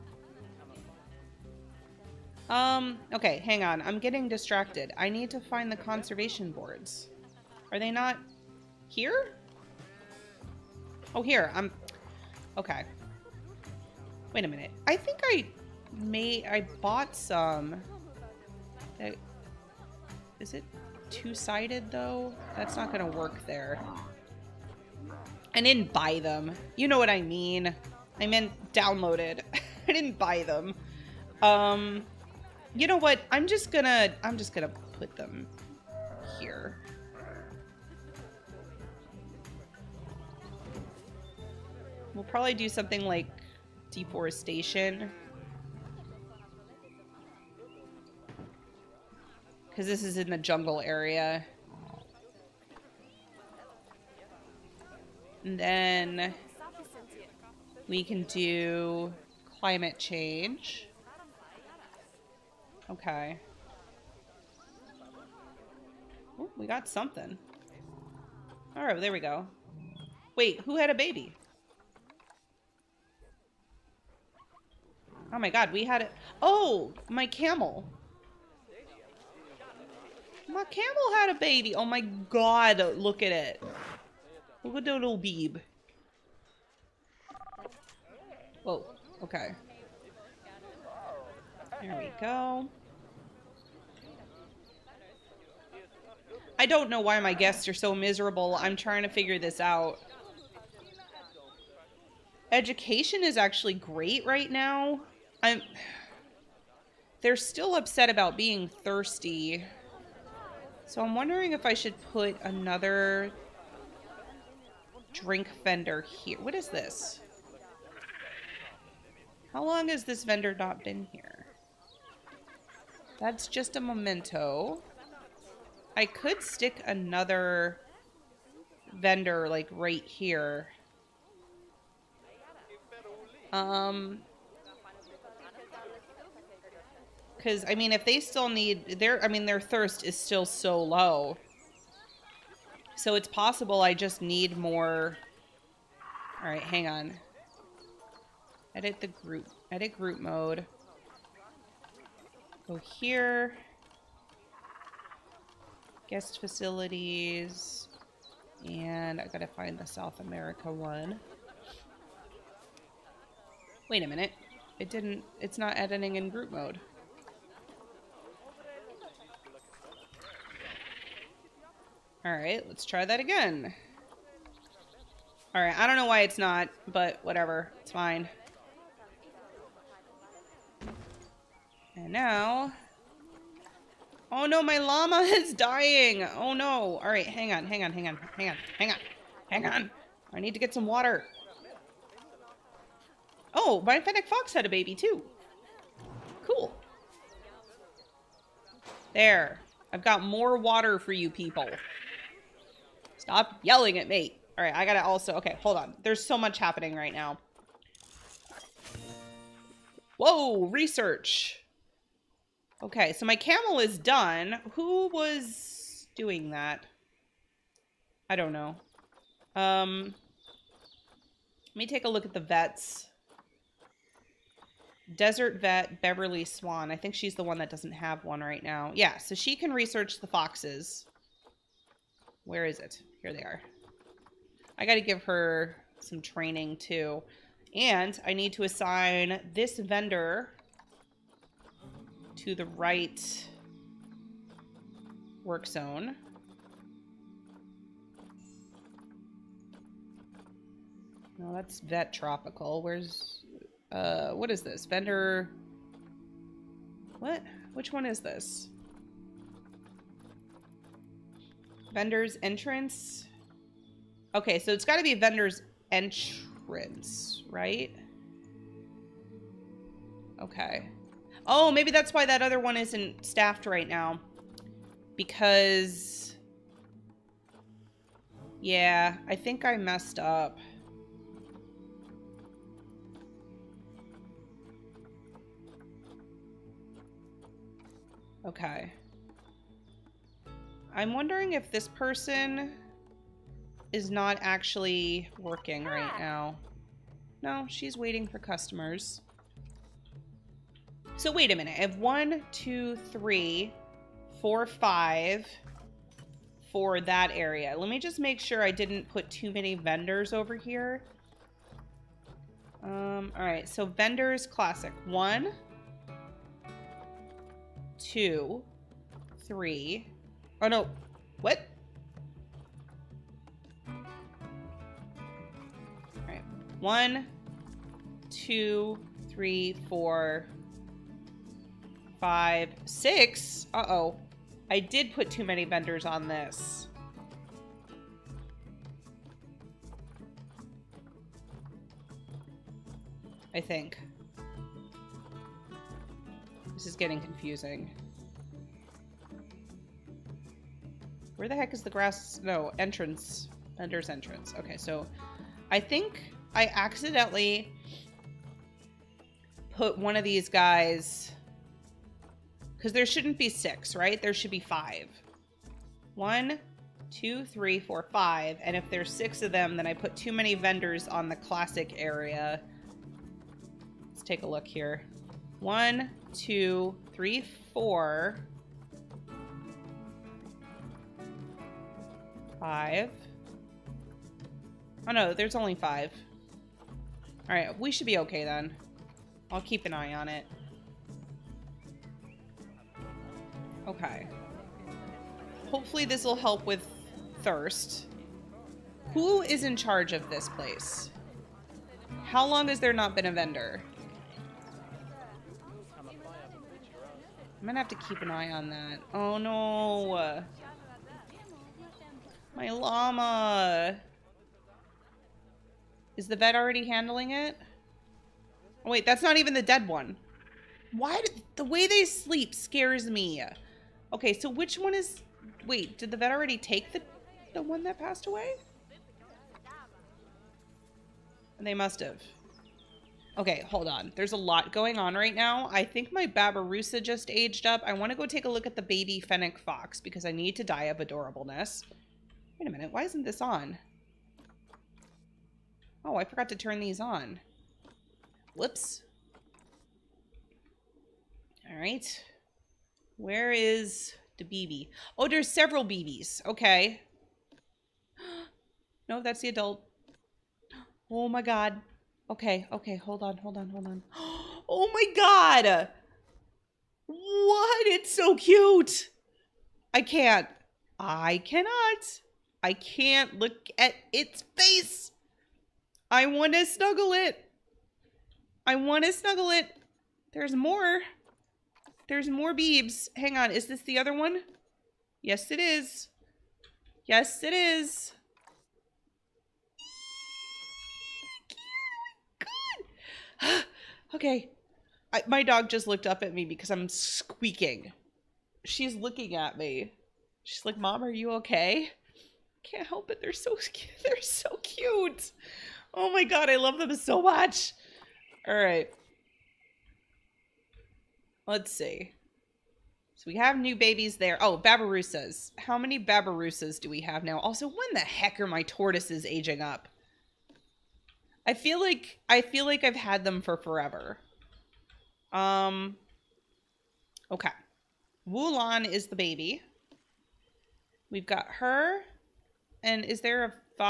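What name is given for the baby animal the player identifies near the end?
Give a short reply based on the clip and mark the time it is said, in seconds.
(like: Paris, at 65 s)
Wulan, at 528 s.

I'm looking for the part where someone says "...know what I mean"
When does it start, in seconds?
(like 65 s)
26 s.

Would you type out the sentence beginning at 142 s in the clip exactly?
So it's possible I just need more.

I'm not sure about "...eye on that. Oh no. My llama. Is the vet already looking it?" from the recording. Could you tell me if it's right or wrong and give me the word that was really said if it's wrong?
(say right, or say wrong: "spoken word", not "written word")
wrong: "handling", not "looking".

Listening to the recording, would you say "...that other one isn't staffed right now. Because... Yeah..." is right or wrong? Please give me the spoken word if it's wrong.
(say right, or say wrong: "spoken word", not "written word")
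right.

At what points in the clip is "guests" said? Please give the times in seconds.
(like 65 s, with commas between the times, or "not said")
97 s, 156 s.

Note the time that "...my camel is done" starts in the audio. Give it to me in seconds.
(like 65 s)
213 s.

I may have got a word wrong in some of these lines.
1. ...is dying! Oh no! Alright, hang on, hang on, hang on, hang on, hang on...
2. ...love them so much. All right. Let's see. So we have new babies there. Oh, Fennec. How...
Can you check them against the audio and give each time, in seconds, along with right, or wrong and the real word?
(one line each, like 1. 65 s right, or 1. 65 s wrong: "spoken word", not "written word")
1. 185 s right
2. 506 s wrong: "Babirusas", not "Fennec".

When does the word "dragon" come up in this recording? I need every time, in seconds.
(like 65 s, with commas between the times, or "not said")
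not said.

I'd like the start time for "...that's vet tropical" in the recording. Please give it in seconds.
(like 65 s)
251 s.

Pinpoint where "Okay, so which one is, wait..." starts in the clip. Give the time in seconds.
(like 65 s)
424 s.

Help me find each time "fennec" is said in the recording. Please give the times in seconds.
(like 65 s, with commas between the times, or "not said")
194 s, 439 s.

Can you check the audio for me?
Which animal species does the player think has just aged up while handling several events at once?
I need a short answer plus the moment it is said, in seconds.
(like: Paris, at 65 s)
Babirusa, at 436 s.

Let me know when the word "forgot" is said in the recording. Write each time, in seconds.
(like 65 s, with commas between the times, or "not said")
446 s.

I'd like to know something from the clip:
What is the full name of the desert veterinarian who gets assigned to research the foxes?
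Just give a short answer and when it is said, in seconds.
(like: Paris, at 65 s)
Beverly Swan, at 226 s.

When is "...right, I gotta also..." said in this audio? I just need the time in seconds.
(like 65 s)
204 s.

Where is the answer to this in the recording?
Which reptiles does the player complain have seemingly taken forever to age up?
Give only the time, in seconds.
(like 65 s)
518 s.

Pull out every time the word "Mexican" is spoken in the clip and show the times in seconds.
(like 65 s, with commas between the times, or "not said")
not said.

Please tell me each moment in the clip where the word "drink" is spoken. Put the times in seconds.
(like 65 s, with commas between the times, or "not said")
115 s.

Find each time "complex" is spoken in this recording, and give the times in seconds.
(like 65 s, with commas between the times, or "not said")
not said.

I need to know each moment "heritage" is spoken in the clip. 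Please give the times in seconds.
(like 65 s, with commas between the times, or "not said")
not said.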